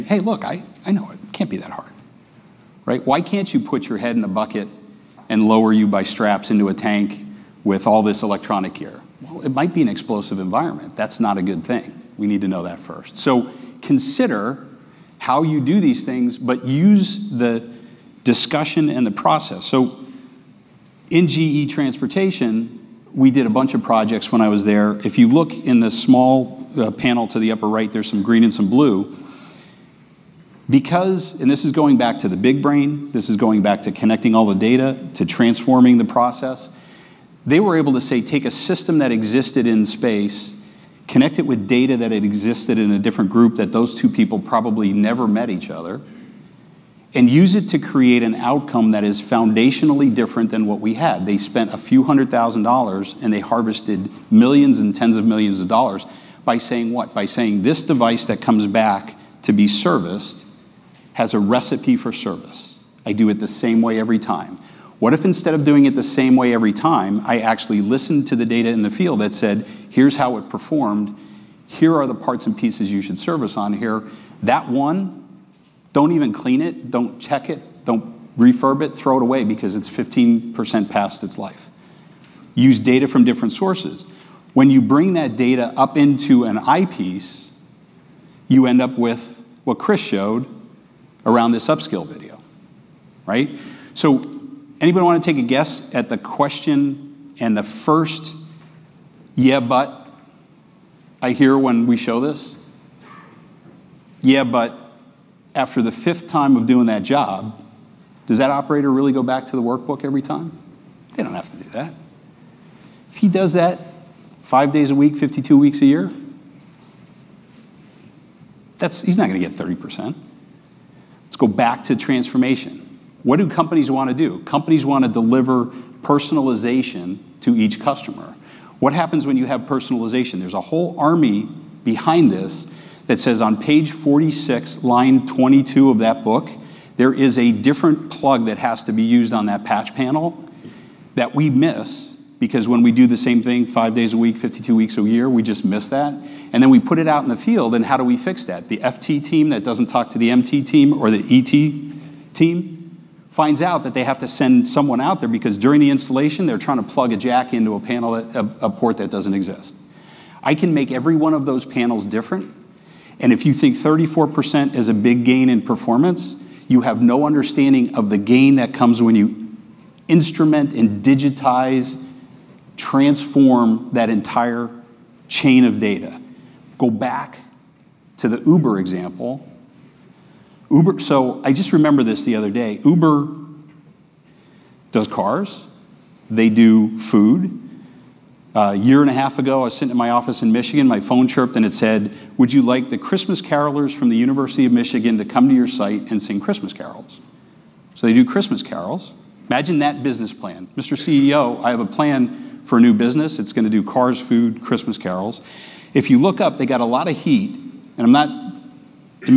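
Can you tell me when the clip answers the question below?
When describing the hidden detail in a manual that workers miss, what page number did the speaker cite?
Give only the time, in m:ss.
2:13.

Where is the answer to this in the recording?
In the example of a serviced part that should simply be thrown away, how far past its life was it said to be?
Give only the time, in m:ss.
1:19.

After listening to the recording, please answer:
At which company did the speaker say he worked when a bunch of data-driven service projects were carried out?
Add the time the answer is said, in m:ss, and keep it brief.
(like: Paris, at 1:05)
GE Transportation, at 0:21.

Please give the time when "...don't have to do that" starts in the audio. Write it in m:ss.
1:51.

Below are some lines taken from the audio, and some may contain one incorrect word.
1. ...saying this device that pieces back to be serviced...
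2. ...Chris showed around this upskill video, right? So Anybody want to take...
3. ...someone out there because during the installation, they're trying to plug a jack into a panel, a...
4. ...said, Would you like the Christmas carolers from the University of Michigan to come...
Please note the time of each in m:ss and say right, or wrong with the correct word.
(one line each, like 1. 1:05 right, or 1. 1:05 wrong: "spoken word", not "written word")
1. 0:57 wrong: "comes", not "pieces"
2. 1:29 right
3. 2:34 right
4. 3:11 right.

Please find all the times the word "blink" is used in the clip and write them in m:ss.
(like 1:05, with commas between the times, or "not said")
not said.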